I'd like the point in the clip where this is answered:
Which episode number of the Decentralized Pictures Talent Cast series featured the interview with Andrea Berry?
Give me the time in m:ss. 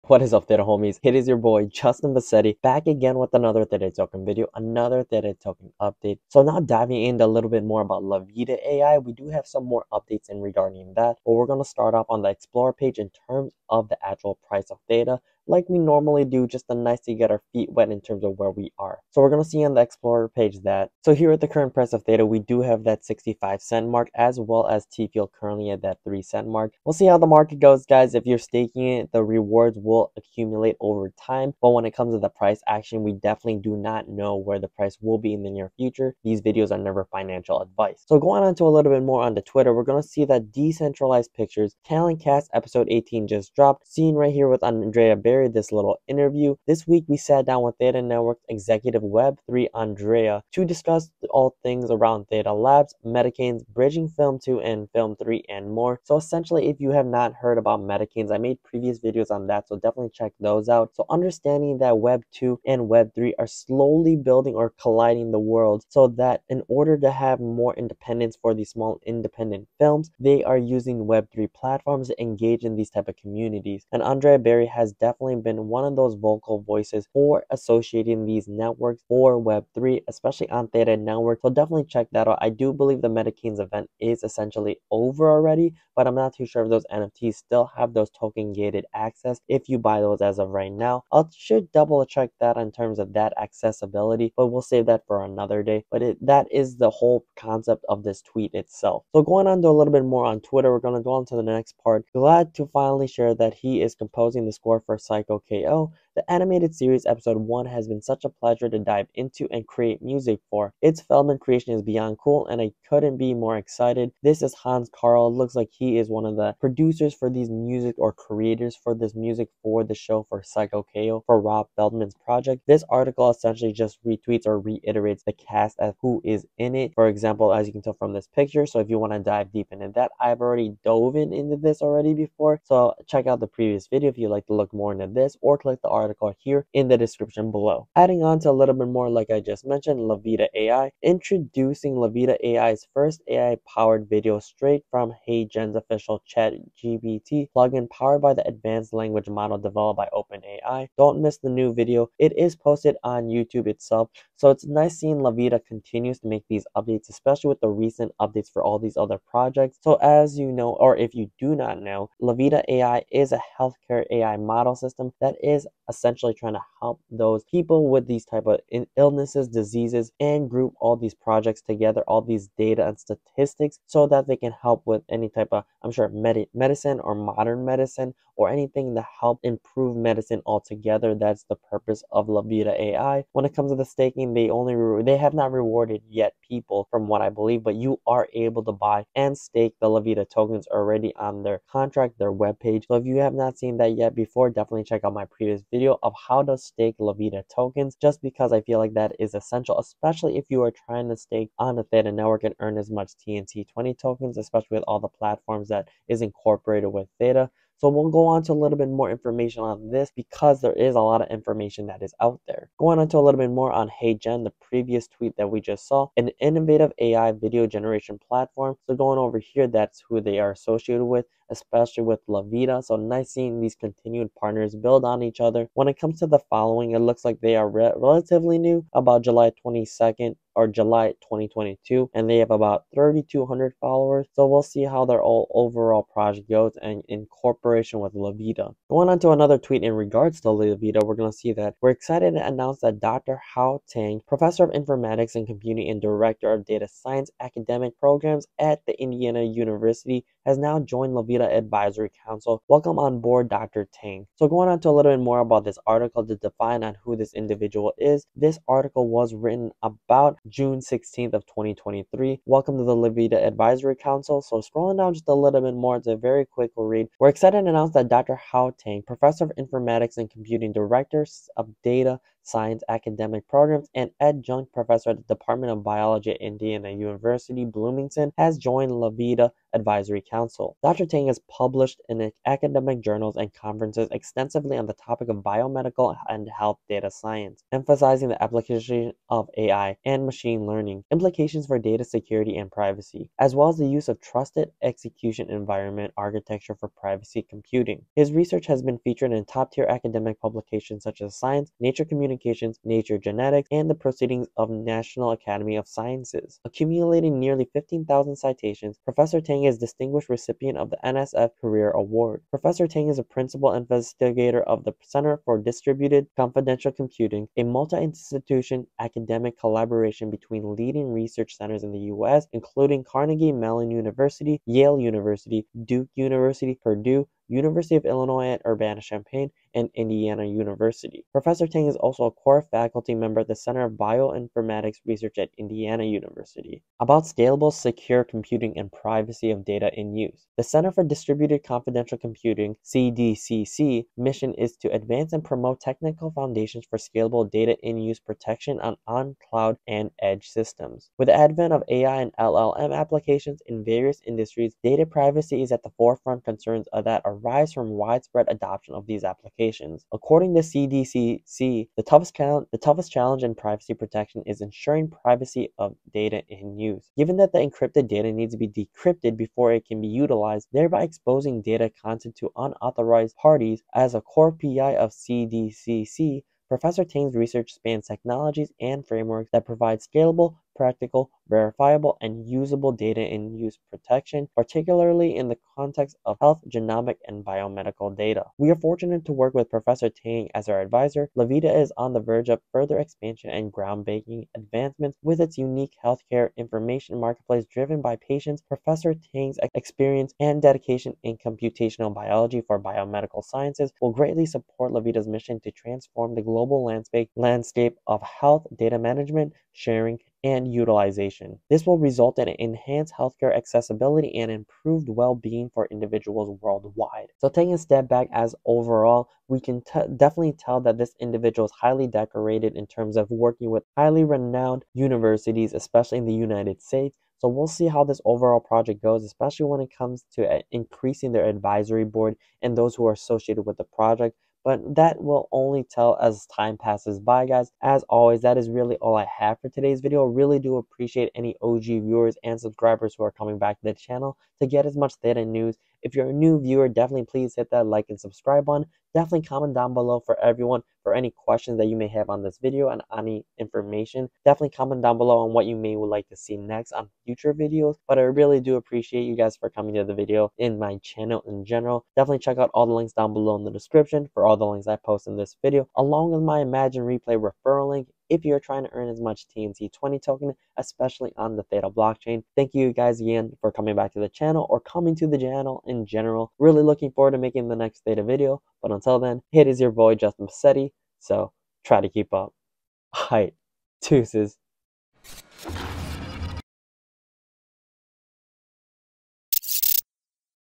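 0:42.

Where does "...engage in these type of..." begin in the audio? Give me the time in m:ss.
1:12.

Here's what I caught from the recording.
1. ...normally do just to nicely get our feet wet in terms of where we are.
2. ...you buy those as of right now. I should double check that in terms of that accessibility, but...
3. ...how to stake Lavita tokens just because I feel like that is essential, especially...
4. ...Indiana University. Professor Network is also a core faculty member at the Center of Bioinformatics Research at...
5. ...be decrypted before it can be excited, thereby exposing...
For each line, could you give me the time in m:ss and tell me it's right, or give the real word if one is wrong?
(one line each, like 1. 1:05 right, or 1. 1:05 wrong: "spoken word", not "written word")
1. 0:15 right
2. 1:29 right
3. 3:16 right
4. 5:29 wrong: "Tang", not "Network"
5. 6:08 wrong: "utilized", not "excited".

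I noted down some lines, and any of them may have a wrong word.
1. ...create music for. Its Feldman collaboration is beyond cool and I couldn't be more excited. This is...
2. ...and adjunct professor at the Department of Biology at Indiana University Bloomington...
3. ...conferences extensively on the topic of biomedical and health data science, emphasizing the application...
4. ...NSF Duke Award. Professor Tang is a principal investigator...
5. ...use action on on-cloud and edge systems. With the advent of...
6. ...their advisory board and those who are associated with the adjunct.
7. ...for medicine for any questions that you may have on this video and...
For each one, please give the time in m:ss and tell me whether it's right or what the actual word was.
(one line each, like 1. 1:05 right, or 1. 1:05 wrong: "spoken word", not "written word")
1. 1:49 wrong: "creation", not "collaboration"
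2. 4:33 right
3. 4:43 right
4. 5:11 wrong: "Career", not "Duke"
5. 5:47 wrong: "protection", not "action"
6. 7:11 wrong: "project", not "adjunct"
7. 7:30 wrong: "everyone", not "medicine".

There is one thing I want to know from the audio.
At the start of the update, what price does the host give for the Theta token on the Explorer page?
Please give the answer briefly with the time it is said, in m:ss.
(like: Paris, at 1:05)
65 cents, at 0:23.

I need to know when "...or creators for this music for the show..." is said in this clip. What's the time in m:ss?
1:57.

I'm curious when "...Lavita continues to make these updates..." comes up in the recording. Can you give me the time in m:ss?
2:35.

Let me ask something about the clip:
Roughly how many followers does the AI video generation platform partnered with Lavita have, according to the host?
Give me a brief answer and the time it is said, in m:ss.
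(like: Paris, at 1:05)
3,200, at 3:52.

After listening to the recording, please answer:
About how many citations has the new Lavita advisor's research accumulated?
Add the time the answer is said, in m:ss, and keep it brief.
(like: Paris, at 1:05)
15,000, at 5:07.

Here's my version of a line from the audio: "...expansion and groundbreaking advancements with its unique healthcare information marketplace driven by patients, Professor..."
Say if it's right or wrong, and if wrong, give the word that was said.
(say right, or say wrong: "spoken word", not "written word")
right.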